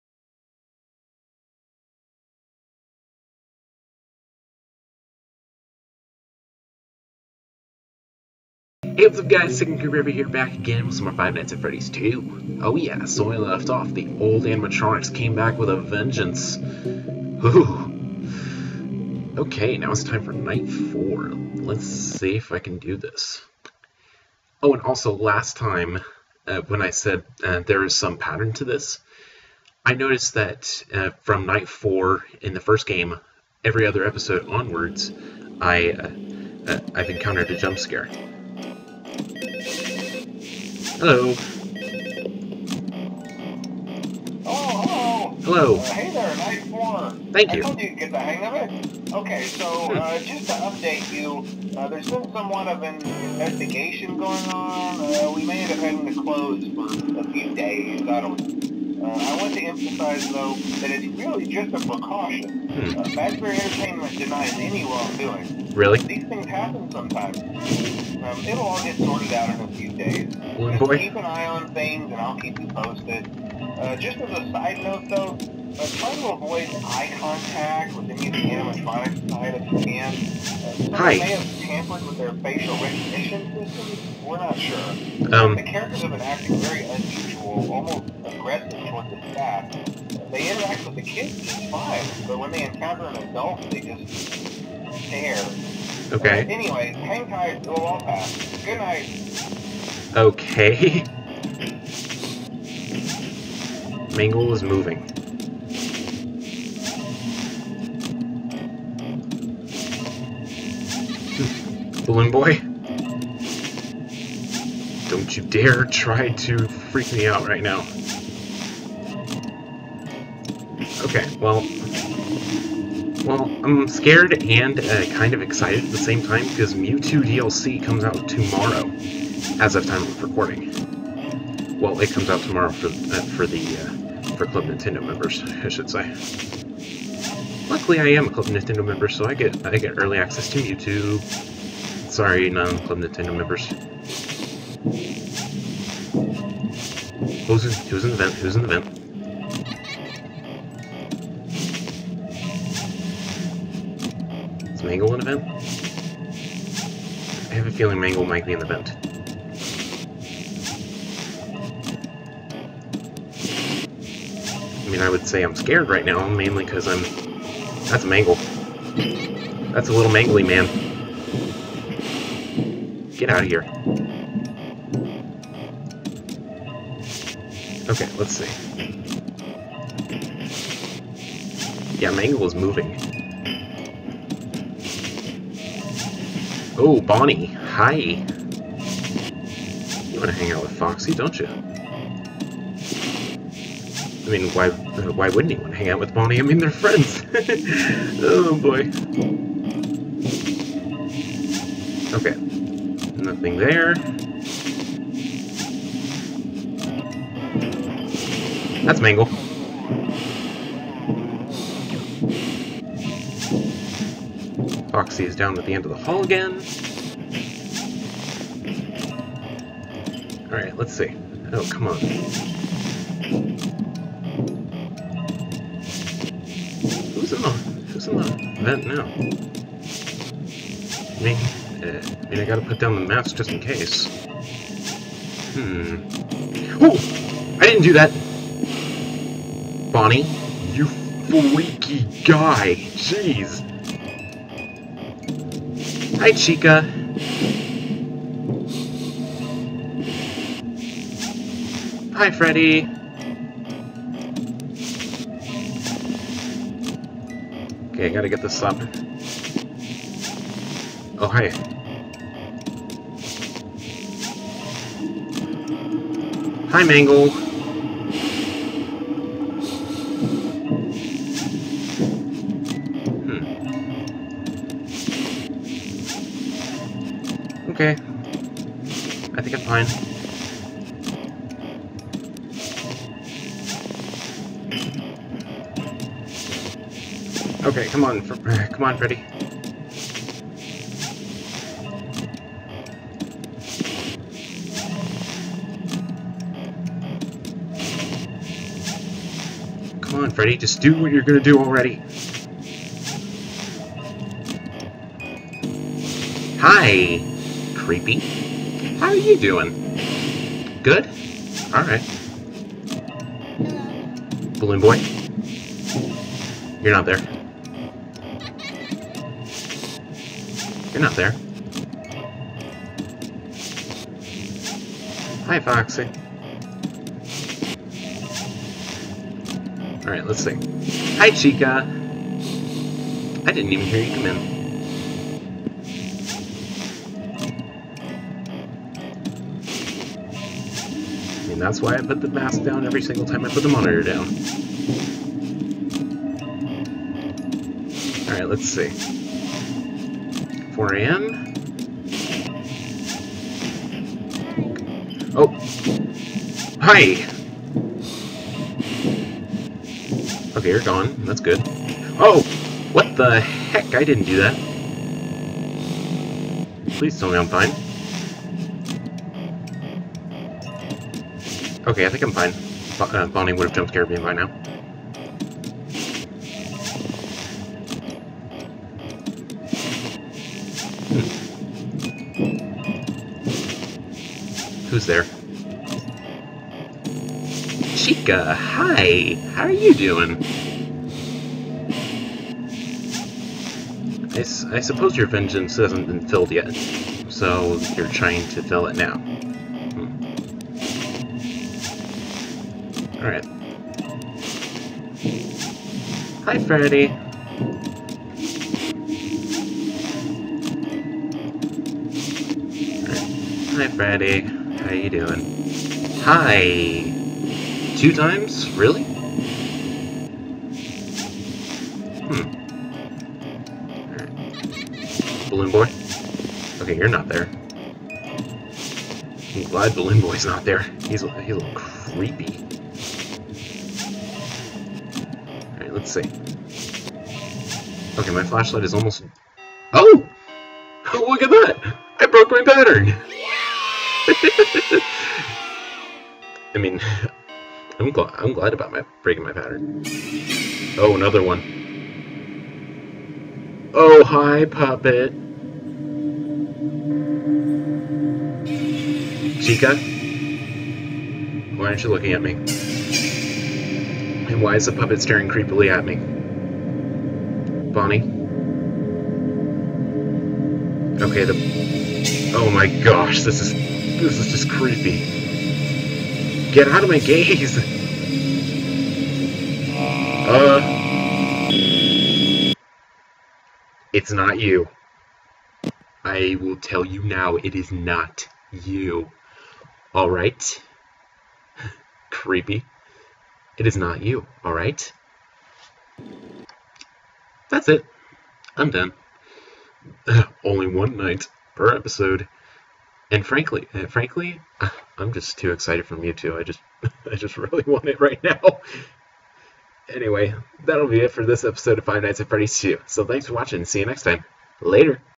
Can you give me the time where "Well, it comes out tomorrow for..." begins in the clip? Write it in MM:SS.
02:11.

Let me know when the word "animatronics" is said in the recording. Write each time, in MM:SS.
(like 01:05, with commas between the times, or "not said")
00:14, 01:18.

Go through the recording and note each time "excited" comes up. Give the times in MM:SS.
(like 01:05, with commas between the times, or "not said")
02:05, 08:25.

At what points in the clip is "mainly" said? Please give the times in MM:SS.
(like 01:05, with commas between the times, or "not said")
02:46.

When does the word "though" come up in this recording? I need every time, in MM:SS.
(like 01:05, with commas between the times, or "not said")
01:00, 01:15.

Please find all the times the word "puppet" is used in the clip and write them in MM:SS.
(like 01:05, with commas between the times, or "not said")
07:34, 07:44.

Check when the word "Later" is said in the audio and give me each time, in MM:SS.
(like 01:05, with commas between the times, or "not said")
08:34.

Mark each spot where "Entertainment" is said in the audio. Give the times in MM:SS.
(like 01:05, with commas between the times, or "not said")
01:03.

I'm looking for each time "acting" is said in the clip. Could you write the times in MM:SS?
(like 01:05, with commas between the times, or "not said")
01:26.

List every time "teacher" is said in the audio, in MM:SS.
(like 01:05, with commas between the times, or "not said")
not said.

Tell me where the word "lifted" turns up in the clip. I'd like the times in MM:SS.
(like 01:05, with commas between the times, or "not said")
not said.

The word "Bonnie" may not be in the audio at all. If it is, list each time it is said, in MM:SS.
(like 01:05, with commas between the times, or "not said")
03:06, 03:16, 03:59, 06:13, 07:47.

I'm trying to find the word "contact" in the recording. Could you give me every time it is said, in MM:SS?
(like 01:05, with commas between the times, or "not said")
01:17.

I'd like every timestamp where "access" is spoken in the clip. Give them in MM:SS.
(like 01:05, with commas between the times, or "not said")
02:20.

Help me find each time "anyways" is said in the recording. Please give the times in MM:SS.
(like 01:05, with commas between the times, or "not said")
01:36, 08:30.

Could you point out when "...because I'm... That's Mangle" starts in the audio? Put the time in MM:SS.
02:46.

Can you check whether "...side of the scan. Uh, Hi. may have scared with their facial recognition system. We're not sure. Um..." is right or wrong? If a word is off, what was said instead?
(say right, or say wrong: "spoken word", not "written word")
wrong: "tampered", not "scared".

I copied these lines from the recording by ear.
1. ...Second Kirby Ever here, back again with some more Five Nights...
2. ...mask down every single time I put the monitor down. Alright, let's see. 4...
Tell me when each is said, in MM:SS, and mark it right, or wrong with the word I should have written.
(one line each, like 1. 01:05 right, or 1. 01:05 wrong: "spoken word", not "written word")
1. 00:09 right
2. 05:42 right.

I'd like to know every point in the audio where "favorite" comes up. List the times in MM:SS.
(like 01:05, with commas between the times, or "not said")
not said.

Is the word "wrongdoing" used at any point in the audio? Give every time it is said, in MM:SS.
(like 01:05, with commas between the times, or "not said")
01:04.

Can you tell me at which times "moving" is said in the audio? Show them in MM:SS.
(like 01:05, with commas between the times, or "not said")
01:44, 03:02.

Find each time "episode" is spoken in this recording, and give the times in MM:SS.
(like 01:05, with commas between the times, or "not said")
00:34, 08:21, 08:31.